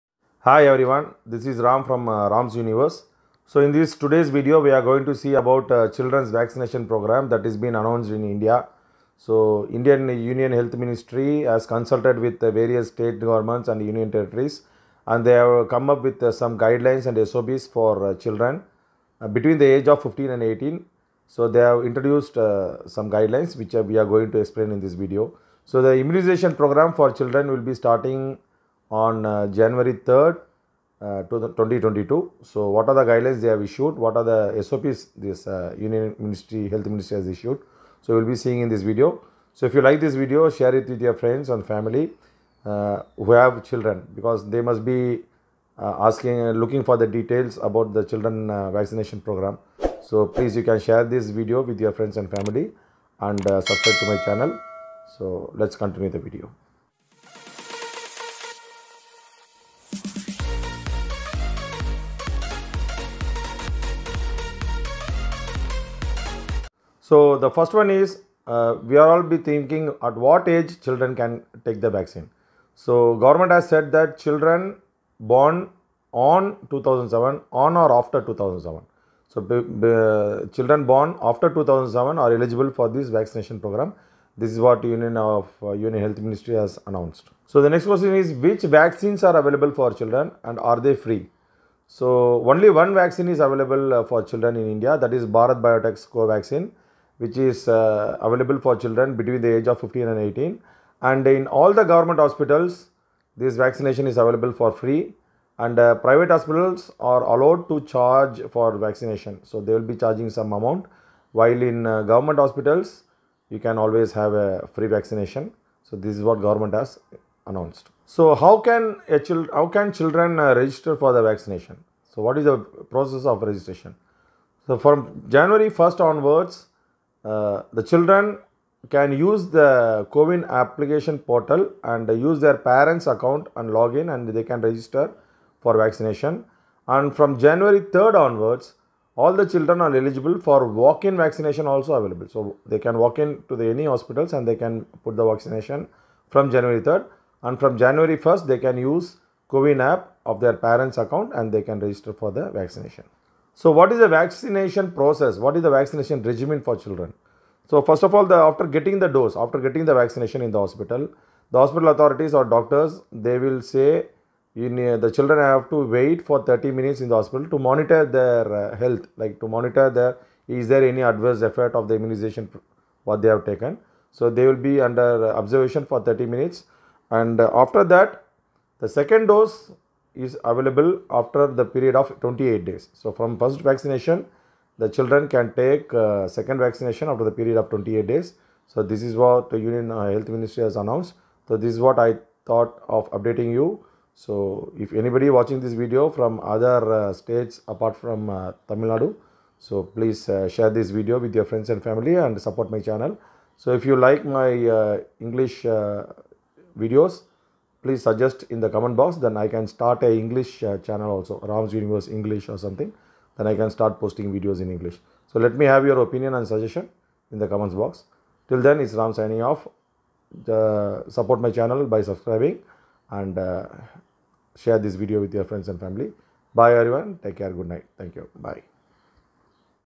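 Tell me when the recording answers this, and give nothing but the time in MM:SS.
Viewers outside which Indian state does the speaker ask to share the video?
03:18.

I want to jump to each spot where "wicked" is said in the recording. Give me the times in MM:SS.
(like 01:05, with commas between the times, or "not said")
not said.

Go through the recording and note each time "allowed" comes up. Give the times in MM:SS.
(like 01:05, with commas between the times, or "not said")
01:47.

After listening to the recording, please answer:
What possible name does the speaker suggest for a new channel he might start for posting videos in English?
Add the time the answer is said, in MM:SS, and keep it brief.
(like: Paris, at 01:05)
Rams Universe English, at 03:31.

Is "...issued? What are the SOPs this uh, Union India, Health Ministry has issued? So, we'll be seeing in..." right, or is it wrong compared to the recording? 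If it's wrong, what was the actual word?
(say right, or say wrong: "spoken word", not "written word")
wrong: "Ministry", not "India".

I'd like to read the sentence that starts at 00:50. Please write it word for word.
So, please you can share this video with your friends and family and subscribe to my channel.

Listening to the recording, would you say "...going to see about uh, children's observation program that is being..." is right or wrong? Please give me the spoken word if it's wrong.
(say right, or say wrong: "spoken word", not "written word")
wrong: "vaccination", not "observation".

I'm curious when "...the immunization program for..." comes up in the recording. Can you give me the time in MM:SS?
00:25.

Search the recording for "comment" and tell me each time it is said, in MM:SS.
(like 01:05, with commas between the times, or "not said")
03:28, 03:37.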